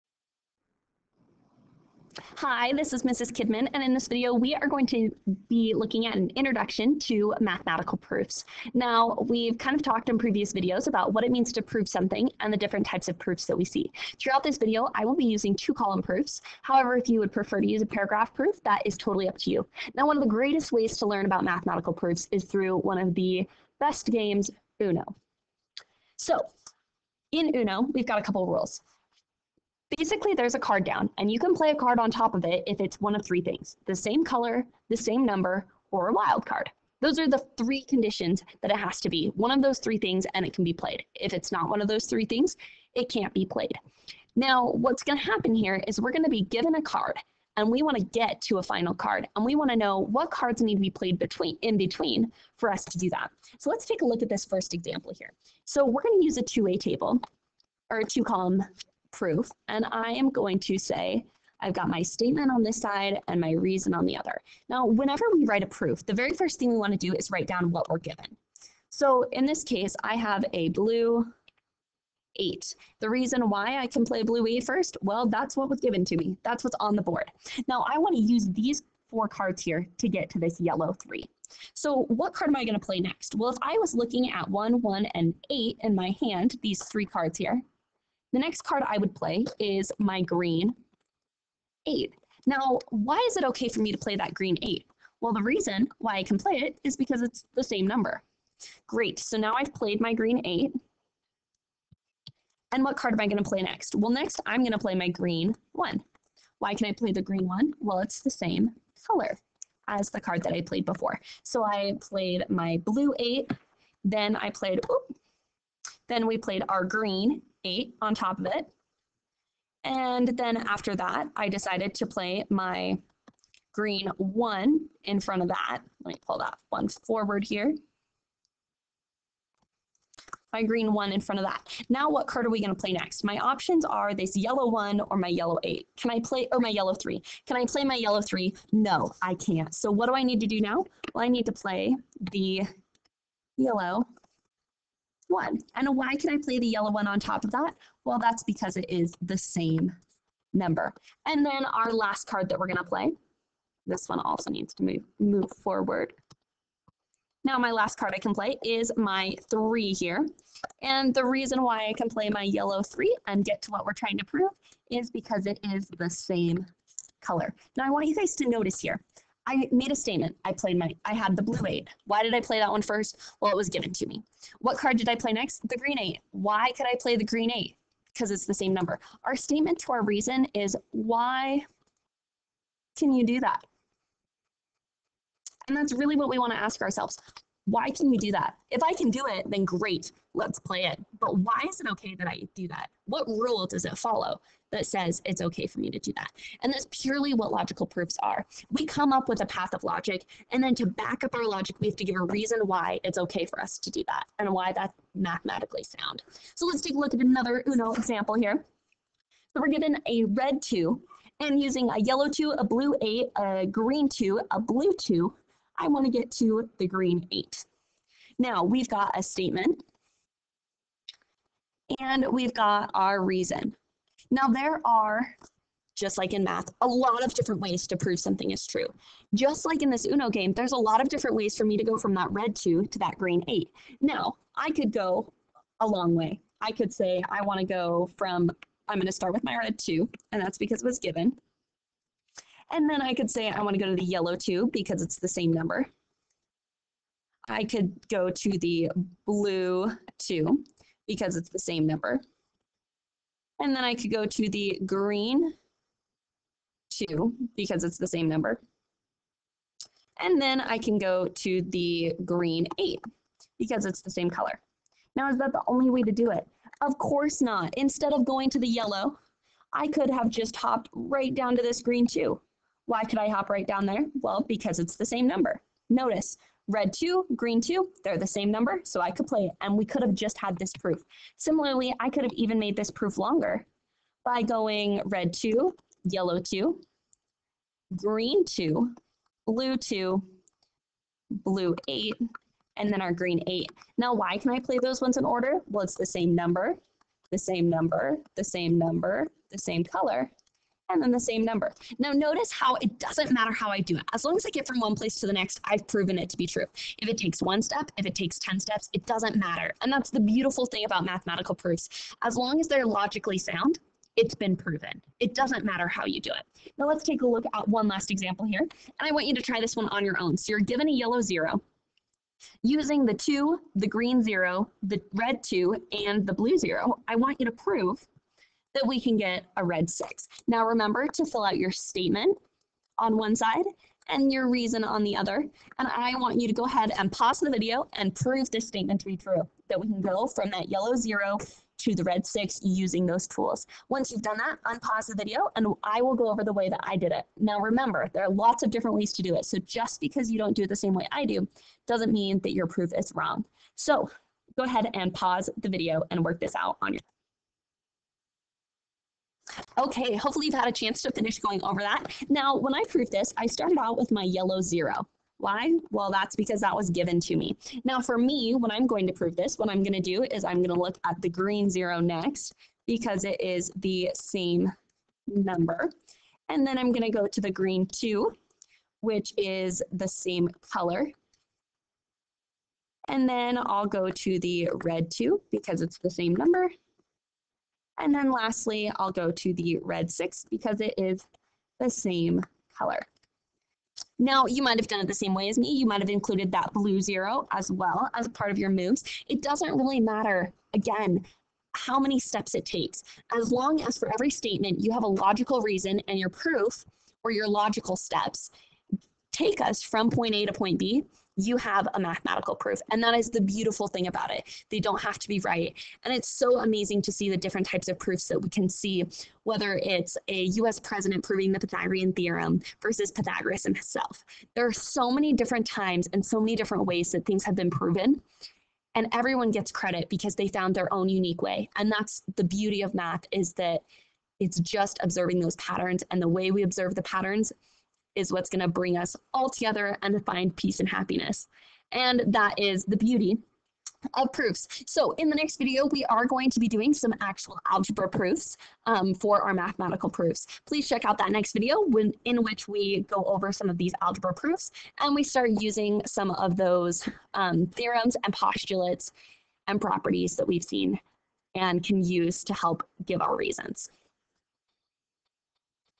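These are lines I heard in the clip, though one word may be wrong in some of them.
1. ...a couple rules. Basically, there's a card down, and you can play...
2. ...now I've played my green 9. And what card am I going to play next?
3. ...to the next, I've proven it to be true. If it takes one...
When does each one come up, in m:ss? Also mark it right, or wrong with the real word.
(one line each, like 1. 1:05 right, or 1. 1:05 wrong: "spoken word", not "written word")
1. 0:28 right
2. 1:39 wrong: "8", not "9"
3. 5:05 right.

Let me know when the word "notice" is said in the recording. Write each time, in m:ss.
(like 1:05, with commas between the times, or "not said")
2:48, 4:35, 5:02.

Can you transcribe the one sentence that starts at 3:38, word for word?
Now we've got a statement and we've got our reason.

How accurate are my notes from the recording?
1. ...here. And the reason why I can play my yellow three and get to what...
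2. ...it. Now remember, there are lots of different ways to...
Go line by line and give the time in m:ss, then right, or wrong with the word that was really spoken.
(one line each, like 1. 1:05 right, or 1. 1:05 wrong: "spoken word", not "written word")
1. 2:39 right
2. 5:47 right.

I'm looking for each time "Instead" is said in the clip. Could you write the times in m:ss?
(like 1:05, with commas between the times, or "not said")
4:27.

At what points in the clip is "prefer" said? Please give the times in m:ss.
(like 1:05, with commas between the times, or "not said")
0:17.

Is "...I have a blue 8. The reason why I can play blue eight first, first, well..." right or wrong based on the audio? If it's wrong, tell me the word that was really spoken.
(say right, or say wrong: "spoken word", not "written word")
right.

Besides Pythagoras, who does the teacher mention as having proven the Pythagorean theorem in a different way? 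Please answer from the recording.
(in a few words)
a US president.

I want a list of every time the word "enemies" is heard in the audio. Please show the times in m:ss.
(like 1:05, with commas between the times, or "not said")
not said.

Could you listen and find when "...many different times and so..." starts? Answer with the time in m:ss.
7:05.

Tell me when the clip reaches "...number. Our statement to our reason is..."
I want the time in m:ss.
2:58.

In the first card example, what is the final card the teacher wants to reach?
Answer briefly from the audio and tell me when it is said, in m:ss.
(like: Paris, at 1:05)
yellow 3, at 1:20.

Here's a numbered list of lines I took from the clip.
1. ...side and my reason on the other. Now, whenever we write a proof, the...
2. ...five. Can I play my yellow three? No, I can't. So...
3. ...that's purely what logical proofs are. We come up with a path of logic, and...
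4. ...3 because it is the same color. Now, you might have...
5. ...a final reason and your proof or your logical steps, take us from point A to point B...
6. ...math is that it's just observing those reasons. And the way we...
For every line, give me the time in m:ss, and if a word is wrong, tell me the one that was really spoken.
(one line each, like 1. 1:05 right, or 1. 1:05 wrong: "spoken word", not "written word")
1. 1:02 right
2. 2:16 wrong: "three", not "five"
3. 3:16 right
4. 6:30 wrong: "6", not "3"
5. 6:45 wrong: "logical", not "final"
6. 7:12 wrong: "patterns", not "reasons".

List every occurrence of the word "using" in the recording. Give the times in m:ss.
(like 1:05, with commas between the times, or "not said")
0:15, 3:31, 5:22, 5:42, 7:35.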